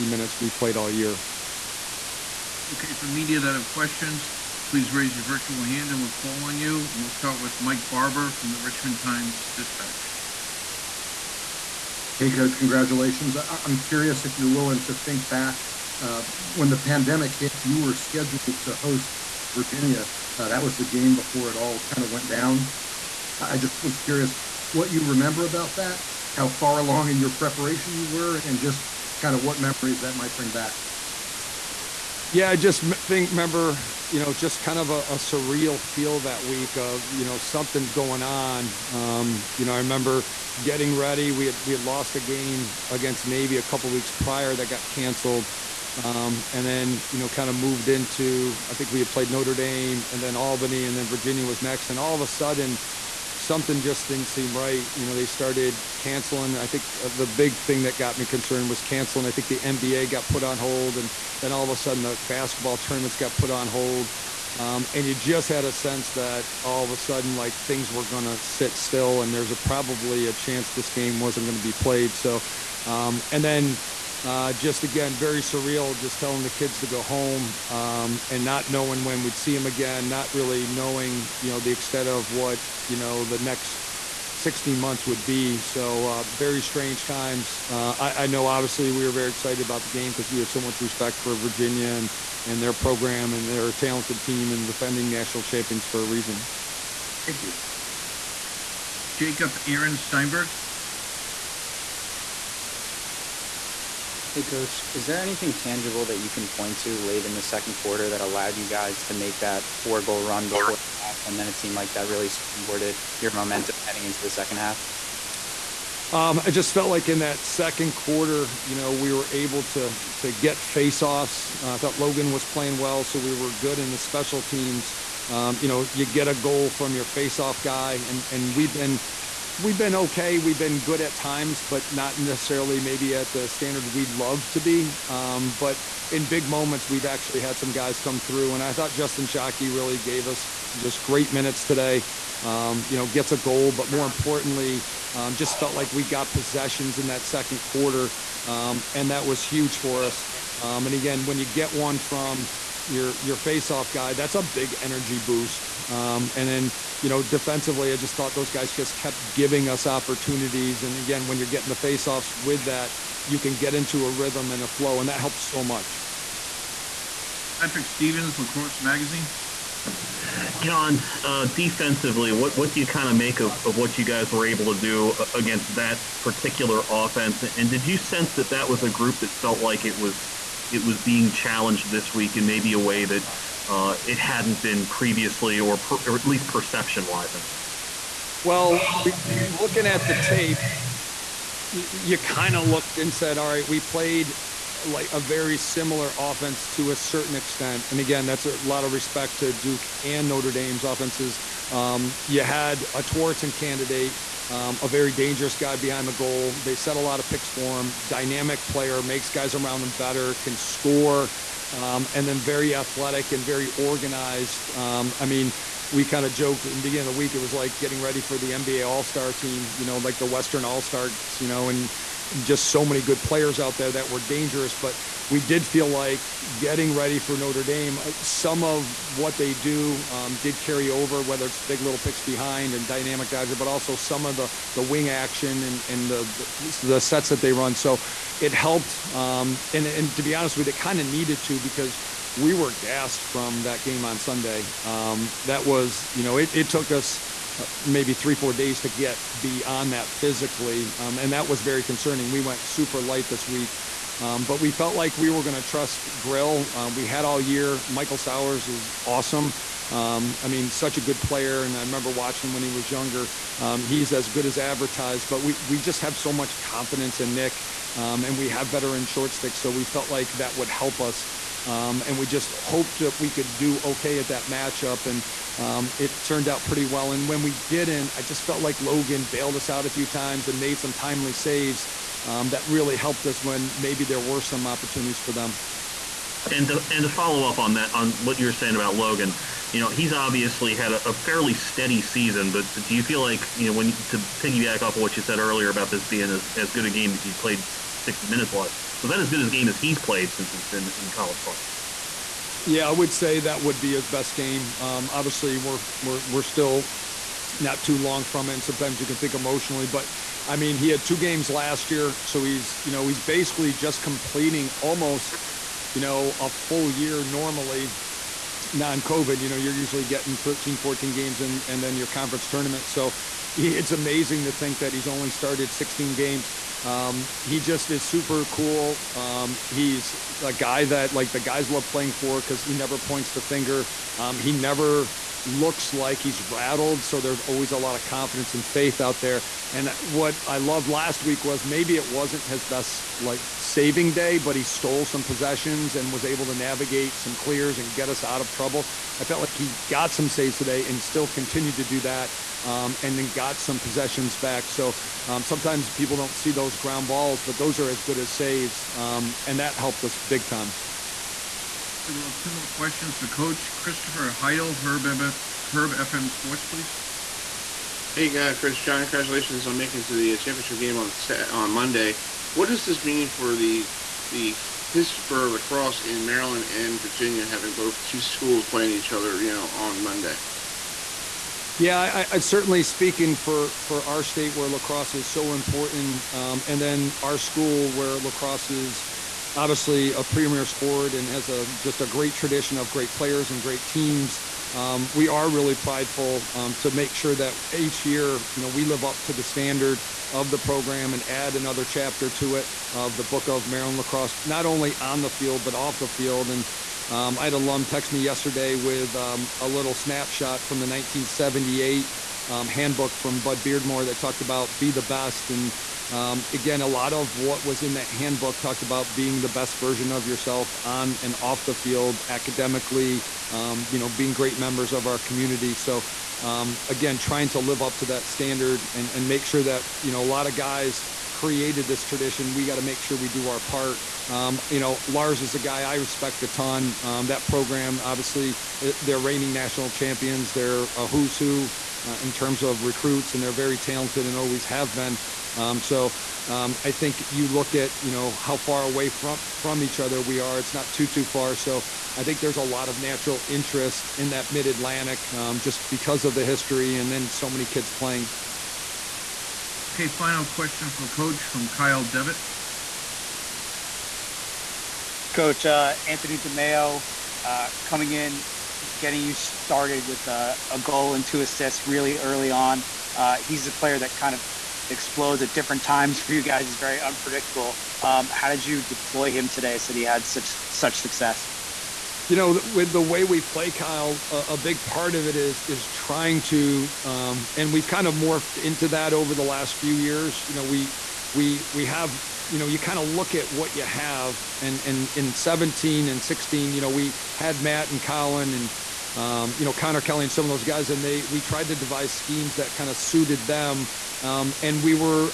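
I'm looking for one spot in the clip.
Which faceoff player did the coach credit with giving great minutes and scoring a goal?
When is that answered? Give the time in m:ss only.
2:18.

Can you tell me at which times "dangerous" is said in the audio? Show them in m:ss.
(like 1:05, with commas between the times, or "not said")
3:25, 3:44.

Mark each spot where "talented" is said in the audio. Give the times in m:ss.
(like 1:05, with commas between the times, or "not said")
1:33, 7:23.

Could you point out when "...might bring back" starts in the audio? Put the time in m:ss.
0:30.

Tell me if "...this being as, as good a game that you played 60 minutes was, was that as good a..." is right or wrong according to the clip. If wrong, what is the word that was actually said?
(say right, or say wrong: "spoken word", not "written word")
right.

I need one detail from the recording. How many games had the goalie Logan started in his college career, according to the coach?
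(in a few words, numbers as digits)
16.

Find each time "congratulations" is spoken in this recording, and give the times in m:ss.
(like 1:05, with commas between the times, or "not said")
0:12, 6:09.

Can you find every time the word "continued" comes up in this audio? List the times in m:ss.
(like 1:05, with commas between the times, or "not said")
5:51.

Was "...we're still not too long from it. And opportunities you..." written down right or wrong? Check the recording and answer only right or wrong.
wrong.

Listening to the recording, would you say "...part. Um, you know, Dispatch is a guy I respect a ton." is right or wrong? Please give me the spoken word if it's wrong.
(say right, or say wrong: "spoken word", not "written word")
wrong: "Lars", not "Dispatch".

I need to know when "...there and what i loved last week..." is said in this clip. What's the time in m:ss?
5:39.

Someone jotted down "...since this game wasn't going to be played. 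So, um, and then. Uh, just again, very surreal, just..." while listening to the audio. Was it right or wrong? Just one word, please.
wrong.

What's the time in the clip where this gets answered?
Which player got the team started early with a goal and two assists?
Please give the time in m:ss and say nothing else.
7:46.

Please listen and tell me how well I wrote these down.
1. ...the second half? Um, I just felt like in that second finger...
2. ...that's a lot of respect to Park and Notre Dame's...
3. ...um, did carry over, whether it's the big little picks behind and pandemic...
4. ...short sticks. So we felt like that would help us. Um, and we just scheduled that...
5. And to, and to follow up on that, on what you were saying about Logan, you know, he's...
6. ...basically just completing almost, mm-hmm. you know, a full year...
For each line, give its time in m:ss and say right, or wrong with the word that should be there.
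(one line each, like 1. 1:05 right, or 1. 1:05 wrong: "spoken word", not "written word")
1. 1:54 wrong: "quarter", not "finger"
2. 3:18 wrong: "Duke", not "Park"
3. 3:50 wrong: "dynamic", not "pandemic"
4. 4:29 wrong: "hoped", not "scheduled"
5. 4:46 right
6. 5:13 right.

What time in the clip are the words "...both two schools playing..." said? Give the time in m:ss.
6:17.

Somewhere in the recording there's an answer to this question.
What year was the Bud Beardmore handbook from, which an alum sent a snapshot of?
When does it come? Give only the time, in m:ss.
6:50.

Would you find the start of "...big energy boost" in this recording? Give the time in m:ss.
2:34.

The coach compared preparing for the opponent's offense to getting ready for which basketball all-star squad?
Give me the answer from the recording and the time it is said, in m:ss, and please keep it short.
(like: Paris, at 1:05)
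Western All Stars, at 3:40.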